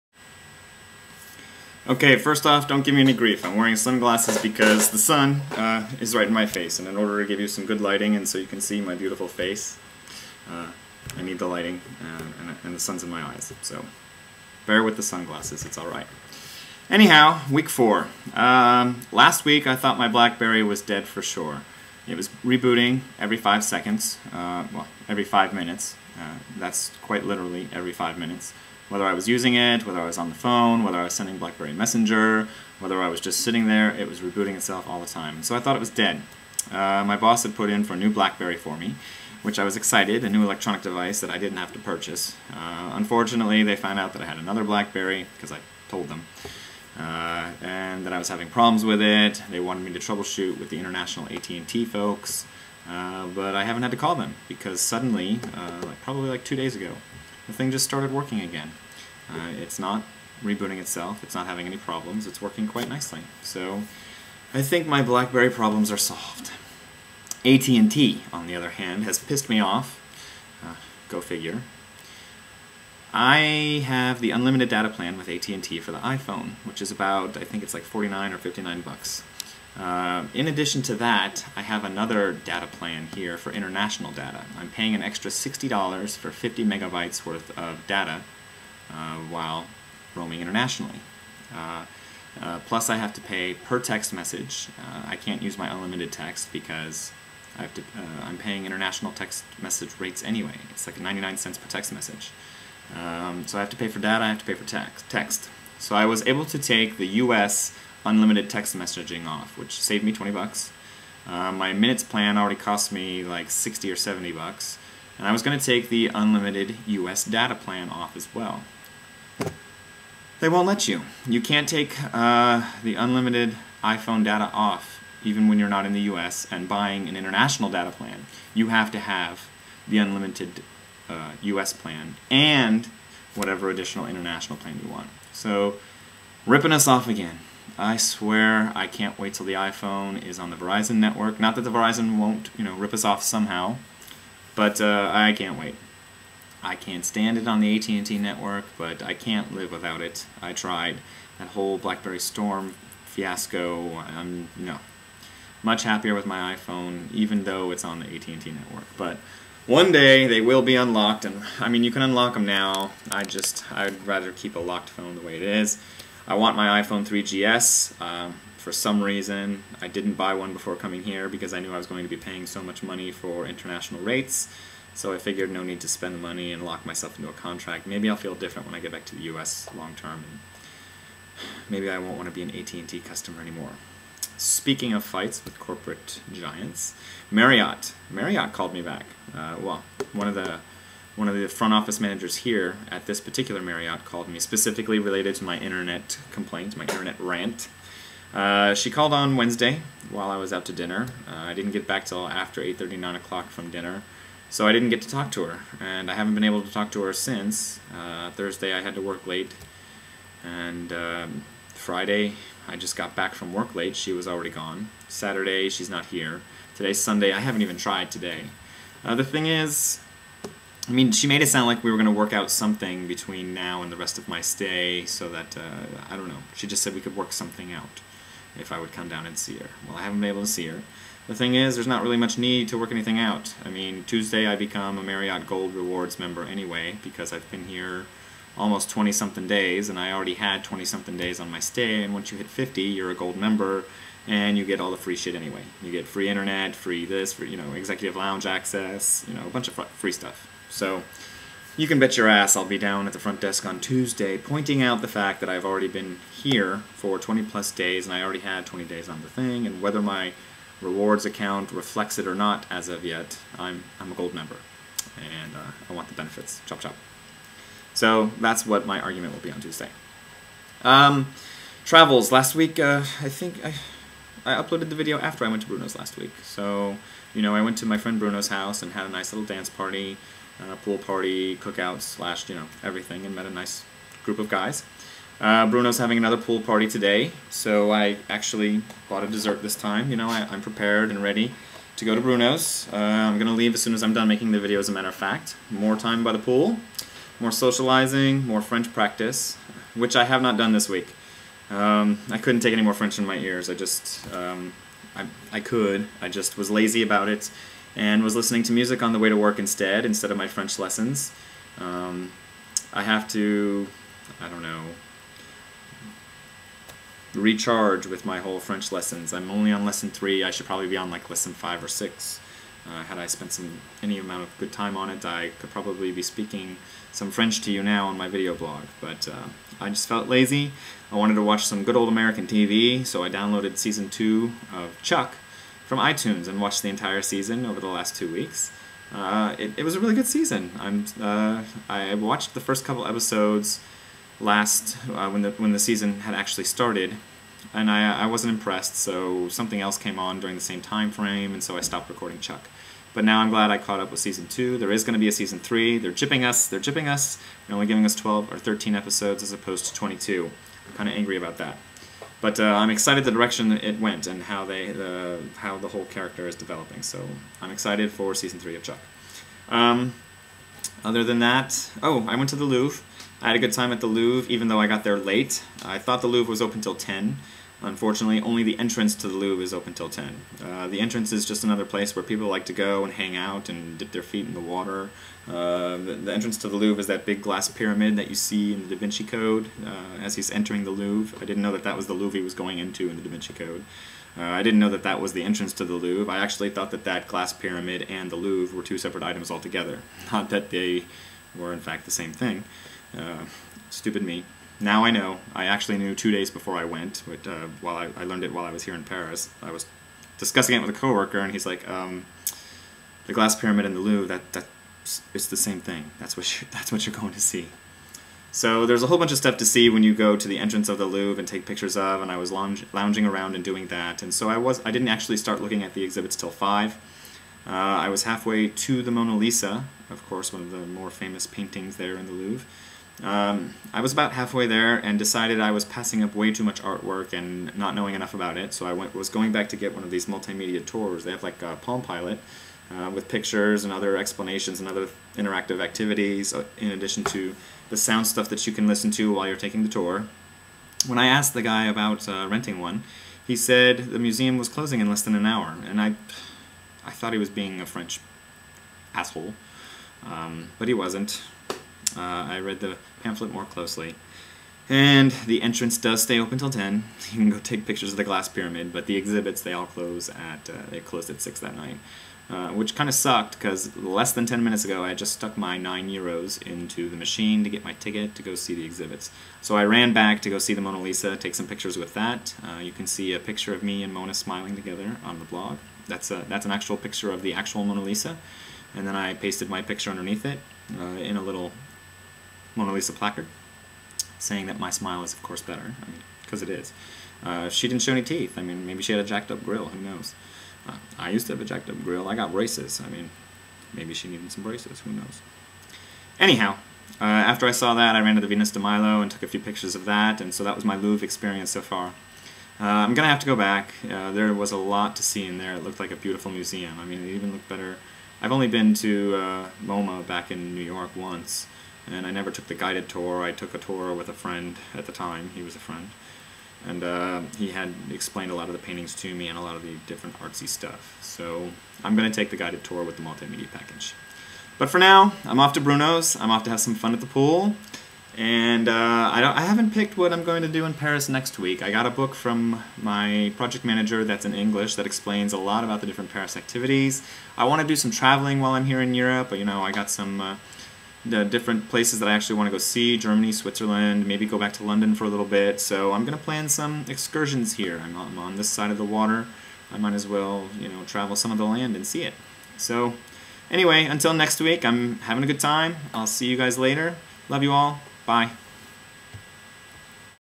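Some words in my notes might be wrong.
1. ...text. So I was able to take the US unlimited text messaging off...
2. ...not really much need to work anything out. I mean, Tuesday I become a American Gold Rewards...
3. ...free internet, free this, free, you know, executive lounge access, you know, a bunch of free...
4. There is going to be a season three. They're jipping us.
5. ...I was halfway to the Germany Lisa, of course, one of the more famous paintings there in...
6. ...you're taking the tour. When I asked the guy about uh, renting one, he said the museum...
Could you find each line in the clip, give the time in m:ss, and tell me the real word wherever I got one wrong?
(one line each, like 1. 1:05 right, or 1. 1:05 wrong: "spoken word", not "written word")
1. 1:44 right
2. 3:51 wrong: "Marriott", not "American"
3. 4:06 right
4. 5:54 right
5. 7:07 wrong: "Mona", not "Germany"
6. 7:29 right.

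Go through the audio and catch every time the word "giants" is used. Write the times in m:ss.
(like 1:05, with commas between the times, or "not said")
3:06.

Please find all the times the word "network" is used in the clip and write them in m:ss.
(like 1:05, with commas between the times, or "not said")
2:20, 2:28, 2:38.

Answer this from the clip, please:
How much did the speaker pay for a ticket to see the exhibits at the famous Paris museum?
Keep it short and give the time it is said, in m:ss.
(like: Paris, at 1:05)
9 euros, at 7:55.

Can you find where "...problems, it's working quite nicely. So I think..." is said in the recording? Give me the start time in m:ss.
1:01.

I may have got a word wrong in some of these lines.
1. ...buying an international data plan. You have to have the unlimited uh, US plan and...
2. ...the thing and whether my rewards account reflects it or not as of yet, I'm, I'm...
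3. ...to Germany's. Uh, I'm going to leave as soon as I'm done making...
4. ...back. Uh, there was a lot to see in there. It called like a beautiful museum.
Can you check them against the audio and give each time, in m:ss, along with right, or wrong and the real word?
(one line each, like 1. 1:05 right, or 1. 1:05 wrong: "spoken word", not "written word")
1. 2:06 right
2. 4:19 right
3. 4:52 wrong: "Bruno", not "Germany"
4. 8:33 wrong: "looked", not "called".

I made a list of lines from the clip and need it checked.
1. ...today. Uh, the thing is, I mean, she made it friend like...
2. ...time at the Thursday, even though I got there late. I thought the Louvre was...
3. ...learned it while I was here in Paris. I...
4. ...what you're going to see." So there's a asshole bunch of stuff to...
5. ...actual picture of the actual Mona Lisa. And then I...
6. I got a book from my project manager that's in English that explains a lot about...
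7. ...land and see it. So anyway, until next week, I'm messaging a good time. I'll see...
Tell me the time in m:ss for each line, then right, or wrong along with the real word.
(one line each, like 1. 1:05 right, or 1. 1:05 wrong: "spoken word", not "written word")
1. 3:38 wrong: "sound", not "friend"
2. 6:13 wrong: "Louvre", not "Thursday"
3. 6:48 right
4. 6:56 wrong: "whole", not "asshole"
5. 8:06 right
6. 9:01 right
7. 9:21 wrong: "having", not "messaging".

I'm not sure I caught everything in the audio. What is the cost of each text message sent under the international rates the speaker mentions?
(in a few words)
99 cents.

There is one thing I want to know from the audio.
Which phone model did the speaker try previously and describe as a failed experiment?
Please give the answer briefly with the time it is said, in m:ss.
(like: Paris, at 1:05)
BlackBerry Storm, at 2:31.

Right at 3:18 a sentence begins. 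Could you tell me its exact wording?
Uh, she called on Wednesday while I was out to dinner.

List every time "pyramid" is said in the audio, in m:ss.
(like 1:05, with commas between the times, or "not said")
6:27, 6:37, 6:53, 7:48.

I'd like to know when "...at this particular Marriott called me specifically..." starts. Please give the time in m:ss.
3:12.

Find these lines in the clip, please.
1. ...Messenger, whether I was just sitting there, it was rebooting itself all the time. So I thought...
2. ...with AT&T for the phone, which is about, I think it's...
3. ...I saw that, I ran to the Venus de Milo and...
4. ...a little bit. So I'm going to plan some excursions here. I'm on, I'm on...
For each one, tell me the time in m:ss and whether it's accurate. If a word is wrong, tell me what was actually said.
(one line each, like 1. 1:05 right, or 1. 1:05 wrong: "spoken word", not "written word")
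1. 0:31 right
2. 1:15 wrong: "iPhone", not "phone"
3. 8:27 right
4. 9:15 right.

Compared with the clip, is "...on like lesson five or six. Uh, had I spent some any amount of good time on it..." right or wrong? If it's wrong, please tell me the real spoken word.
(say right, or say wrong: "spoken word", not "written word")
right.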